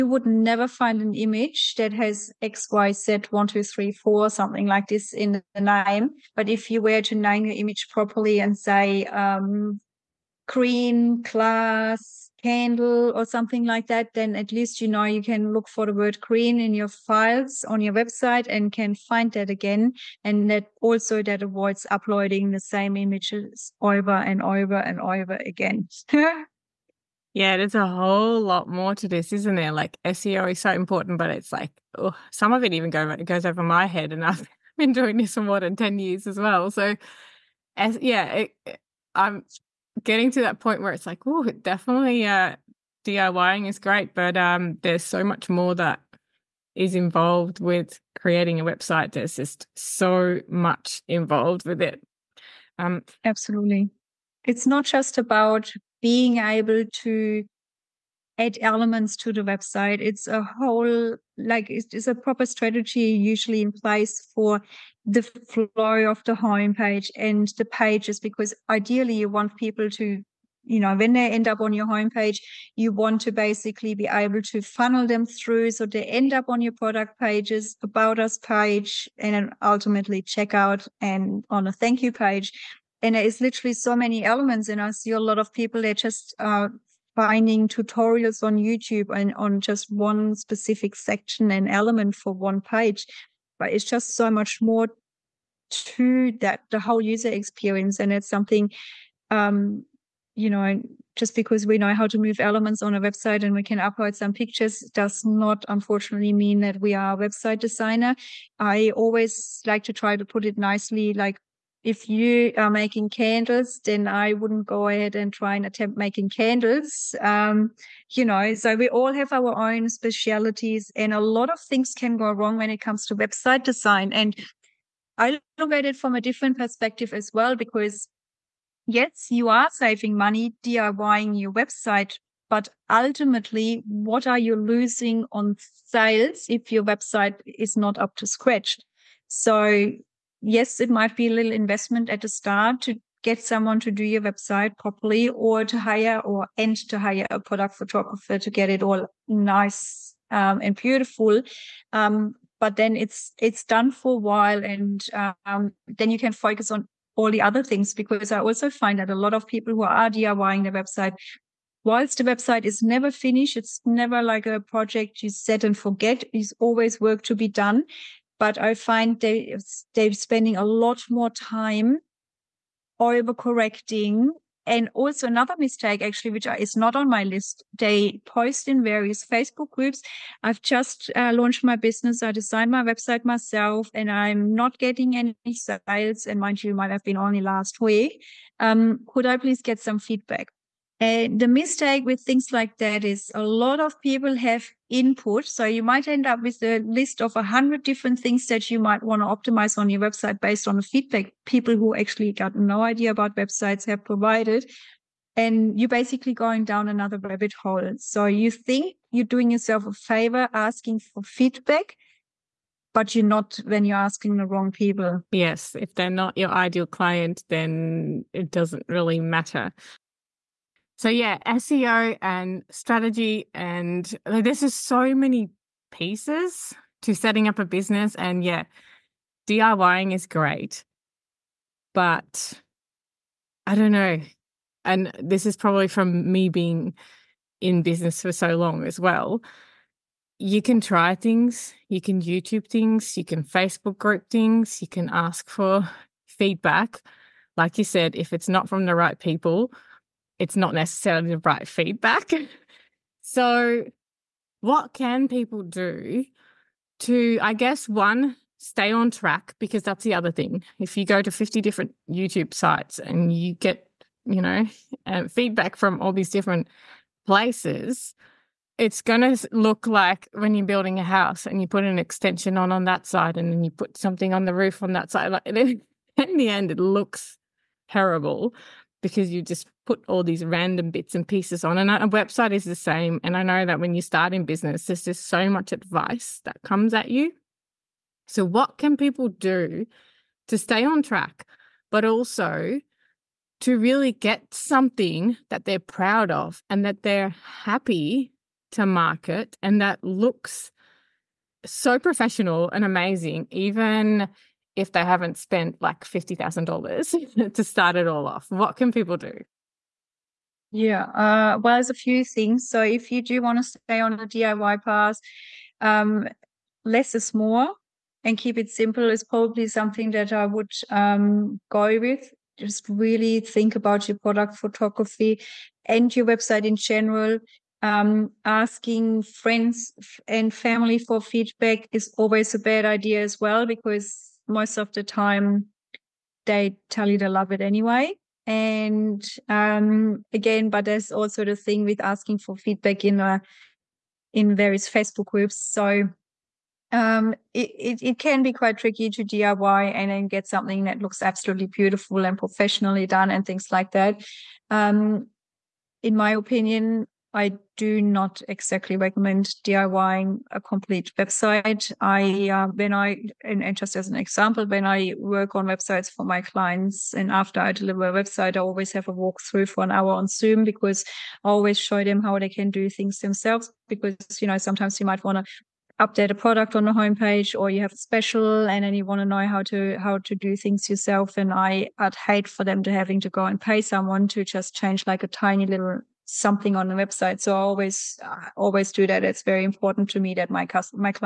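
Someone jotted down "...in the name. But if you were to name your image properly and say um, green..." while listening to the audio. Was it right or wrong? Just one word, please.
right.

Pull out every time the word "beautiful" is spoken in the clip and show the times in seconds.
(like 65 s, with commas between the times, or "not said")
150 s, 351 s.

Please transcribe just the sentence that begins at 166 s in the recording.
It's always work to be done but I find they they're spending a lot more time overcorrecting.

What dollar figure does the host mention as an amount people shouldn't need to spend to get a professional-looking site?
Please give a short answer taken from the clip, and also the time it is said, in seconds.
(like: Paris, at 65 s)
$50,000, at 306 s.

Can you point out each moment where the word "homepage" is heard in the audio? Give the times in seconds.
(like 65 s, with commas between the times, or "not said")
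66 s, 71 s, 376 s.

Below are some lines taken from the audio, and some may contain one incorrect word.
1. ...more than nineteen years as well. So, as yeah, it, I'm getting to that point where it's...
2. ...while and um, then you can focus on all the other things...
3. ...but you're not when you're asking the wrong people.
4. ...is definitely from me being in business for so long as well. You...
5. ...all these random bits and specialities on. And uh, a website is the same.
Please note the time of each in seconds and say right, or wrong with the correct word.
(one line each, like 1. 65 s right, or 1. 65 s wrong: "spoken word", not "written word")
1. 35 s wrong: "ten", not "nineteen"
2. 154 s right
3. 212 s right
4. 235 s wrong: "probably", not "definitely"
5. 280 s wrong: "pieces", not "specialities".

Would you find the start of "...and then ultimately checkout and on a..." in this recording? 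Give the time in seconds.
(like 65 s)
79 s.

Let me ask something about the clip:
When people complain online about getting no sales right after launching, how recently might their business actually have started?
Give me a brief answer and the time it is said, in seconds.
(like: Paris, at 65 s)
last week, at 187 s.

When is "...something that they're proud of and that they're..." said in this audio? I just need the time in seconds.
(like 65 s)
294 s.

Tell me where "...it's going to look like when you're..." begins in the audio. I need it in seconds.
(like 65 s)
268 s.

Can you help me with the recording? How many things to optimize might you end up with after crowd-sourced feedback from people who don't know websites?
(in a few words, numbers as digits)
100.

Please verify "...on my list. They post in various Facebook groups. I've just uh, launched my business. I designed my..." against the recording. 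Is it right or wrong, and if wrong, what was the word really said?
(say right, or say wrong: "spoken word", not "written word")
right.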